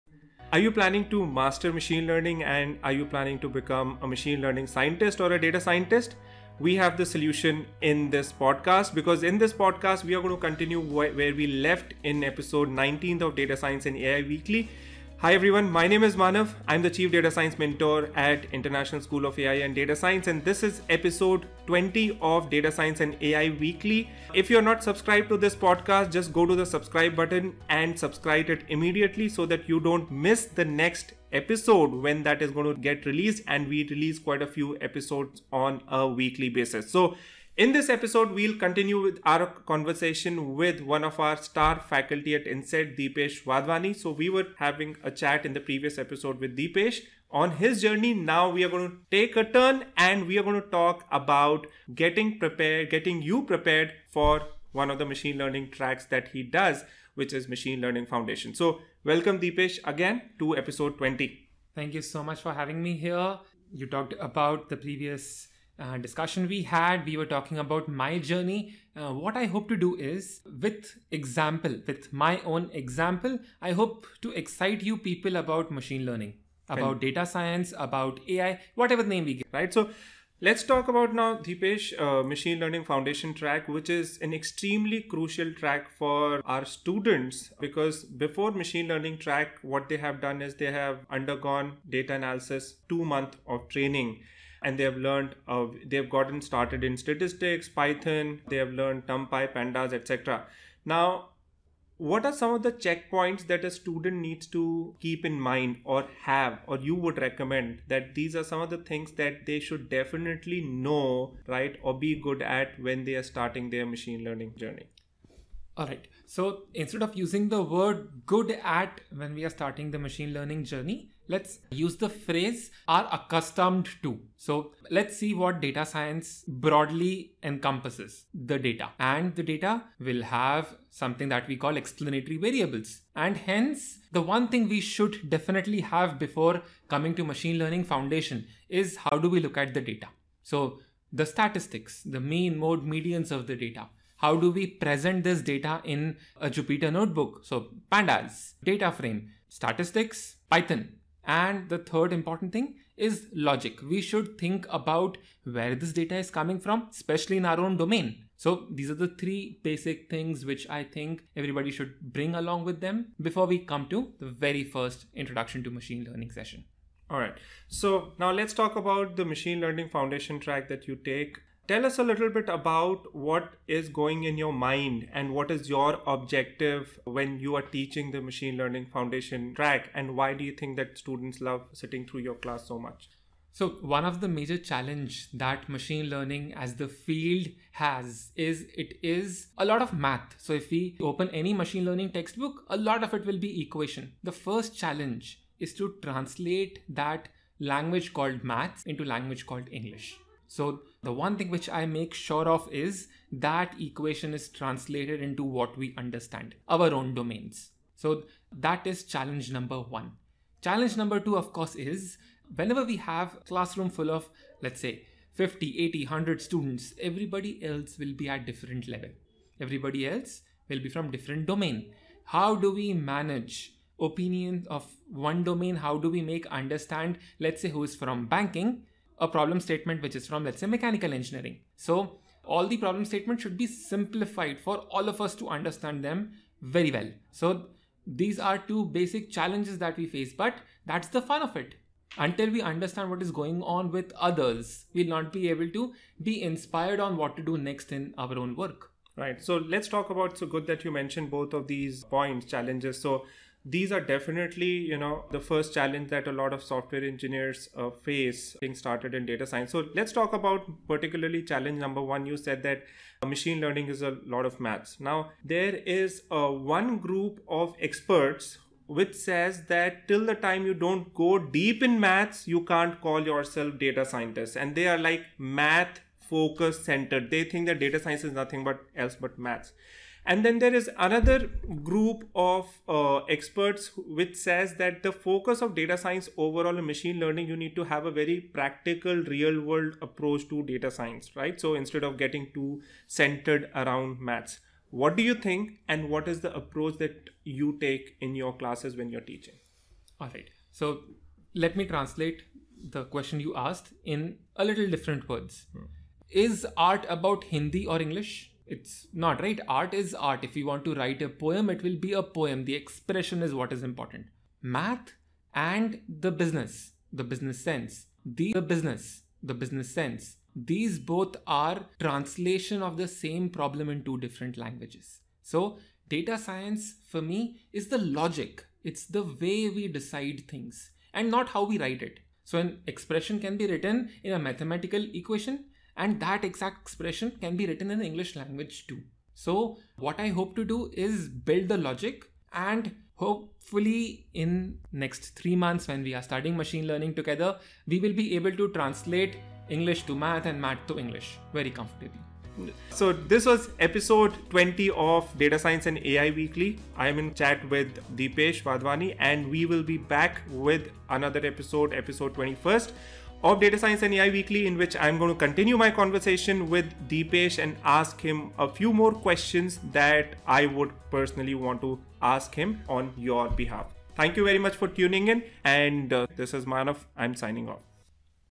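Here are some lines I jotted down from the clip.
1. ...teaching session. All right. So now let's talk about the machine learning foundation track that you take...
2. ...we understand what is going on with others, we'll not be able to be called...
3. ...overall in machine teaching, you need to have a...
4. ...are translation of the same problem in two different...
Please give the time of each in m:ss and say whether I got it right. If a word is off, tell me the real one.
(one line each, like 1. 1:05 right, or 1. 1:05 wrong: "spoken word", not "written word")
1. 2:46 wrong: "learning", not "teaching"
2. 4:02 wrong: "inspired", not "called"
3. 4:46 wrong: "learning", not "teaching"
4. 5:21 right.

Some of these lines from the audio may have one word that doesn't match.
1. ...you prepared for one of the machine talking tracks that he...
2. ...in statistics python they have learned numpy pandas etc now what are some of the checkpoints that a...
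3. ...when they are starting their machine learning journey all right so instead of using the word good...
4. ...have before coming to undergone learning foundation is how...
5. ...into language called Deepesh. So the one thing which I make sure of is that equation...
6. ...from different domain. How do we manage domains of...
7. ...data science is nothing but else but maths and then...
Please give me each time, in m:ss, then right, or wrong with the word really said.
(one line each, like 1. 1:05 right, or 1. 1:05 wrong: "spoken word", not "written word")
1. 0:53 wrong: "learning", not "talking"
2. 1:36 right
3. 1:52 right
4. 2:15 wrong: "machine", not "undergone"
5. 3:18 wrong: "English", not "Deepesh"
6. 3:40 wrong: "opinions", not "domains"
7. 4:37 right.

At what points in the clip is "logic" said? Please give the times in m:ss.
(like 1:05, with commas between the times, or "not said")
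2:33, 5:28, 5:41.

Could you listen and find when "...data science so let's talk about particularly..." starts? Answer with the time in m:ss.
4:19.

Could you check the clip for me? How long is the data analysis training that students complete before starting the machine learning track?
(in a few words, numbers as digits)
2 months.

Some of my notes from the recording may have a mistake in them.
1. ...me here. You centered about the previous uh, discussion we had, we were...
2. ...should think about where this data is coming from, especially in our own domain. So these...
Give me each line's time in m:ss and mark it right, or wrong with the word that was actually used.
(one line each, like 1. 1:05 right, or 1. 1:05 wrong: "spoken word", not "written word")
1. 1:02 wrong: "talked", not "centered"
2. 2:34 right.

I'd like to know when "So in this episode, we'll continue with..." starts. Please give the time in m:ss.
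0:36.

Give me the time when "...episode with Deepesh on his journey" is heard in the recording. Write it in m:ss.
0:45.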